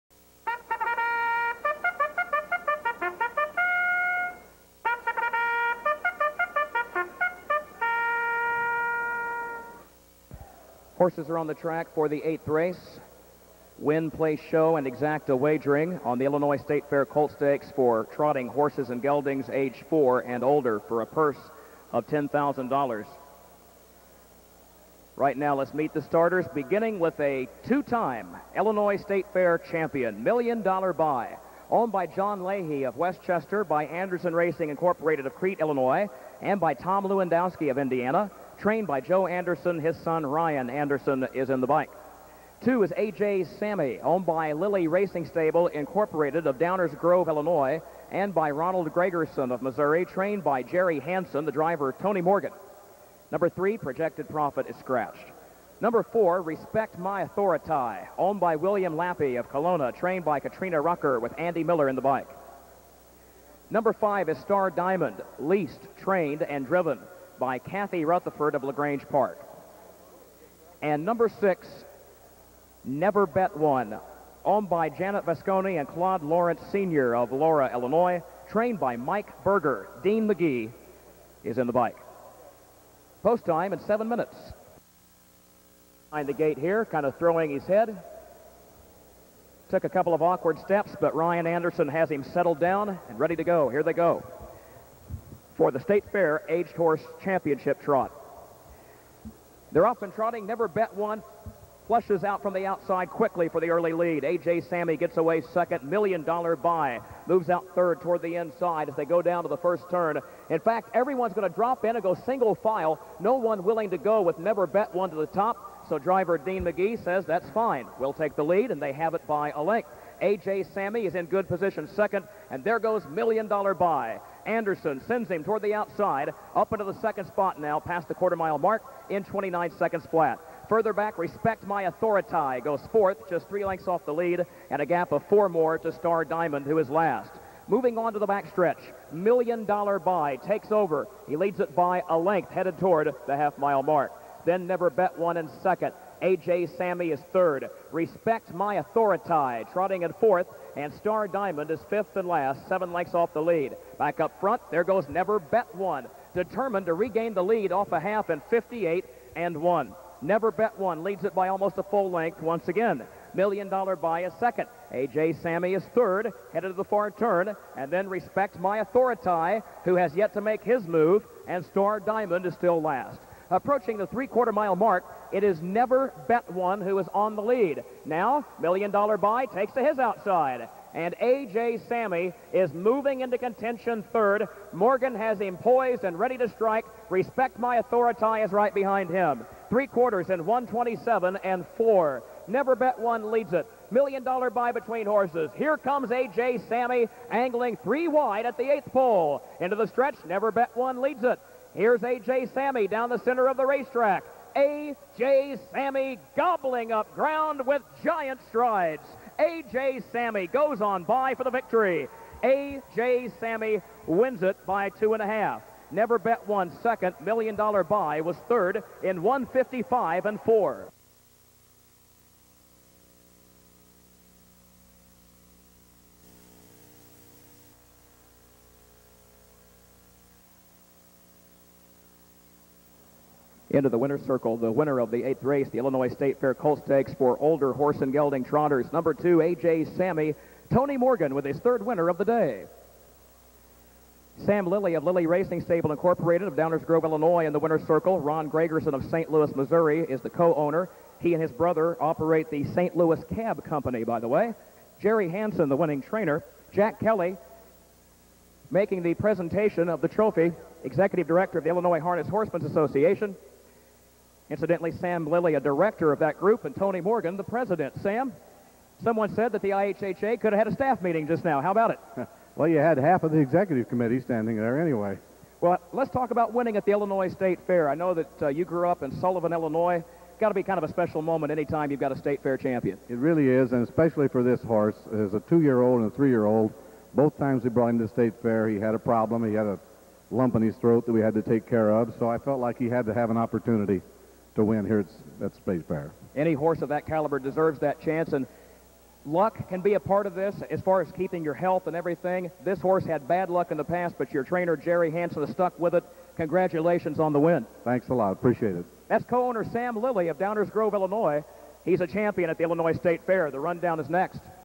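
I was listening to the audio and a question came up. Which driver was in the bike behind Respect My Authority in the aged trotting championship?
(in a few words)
Andy Miller.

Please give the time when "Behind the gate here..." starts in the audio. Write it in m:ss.
1:26.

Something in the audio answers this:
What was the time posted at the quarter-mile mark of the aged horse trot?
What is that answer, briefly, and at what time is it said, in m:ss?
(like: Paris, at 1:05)
29 seconds flat, at 2:09.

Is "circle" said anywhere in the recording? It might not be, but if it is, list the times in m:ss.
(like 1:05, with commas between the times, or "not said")
3:54, 4:07.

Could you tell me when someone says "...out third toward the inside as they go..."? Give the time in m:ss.
1:47.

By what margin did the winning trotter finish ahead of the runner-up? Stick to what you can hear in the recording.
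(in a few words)
two and a half.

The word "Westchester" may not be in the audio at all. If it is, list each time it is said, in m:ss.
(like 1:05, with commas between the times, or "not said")
0:32.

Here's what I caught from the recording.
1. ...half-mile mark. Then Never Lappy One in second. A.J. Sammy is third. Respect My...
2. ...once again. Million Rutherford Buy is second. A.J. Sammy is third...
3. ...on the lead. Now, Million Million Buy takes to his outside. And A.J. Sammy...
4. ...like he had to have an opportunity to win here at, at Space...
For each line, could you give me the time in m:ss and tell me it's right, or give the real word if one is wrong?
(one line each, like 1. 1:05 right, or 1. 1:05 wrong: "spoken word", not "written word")
1. 2:23 wrong: "Bet", not "Lappy"
2. 2:42 wrong: "Dollar", not "Rutherford"
3. 2:57 wrong: "Dollar", not "Million"
4. 4:52 right.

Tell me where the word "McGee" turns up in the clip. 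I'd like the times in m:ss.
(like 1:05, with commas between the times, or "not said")
1:20, 1:56.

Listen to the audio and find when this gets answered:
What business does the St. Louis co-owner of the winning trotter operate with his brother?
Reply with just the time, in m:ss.
4:12.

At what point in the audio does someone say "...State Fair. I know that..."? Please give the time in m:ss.
4:37.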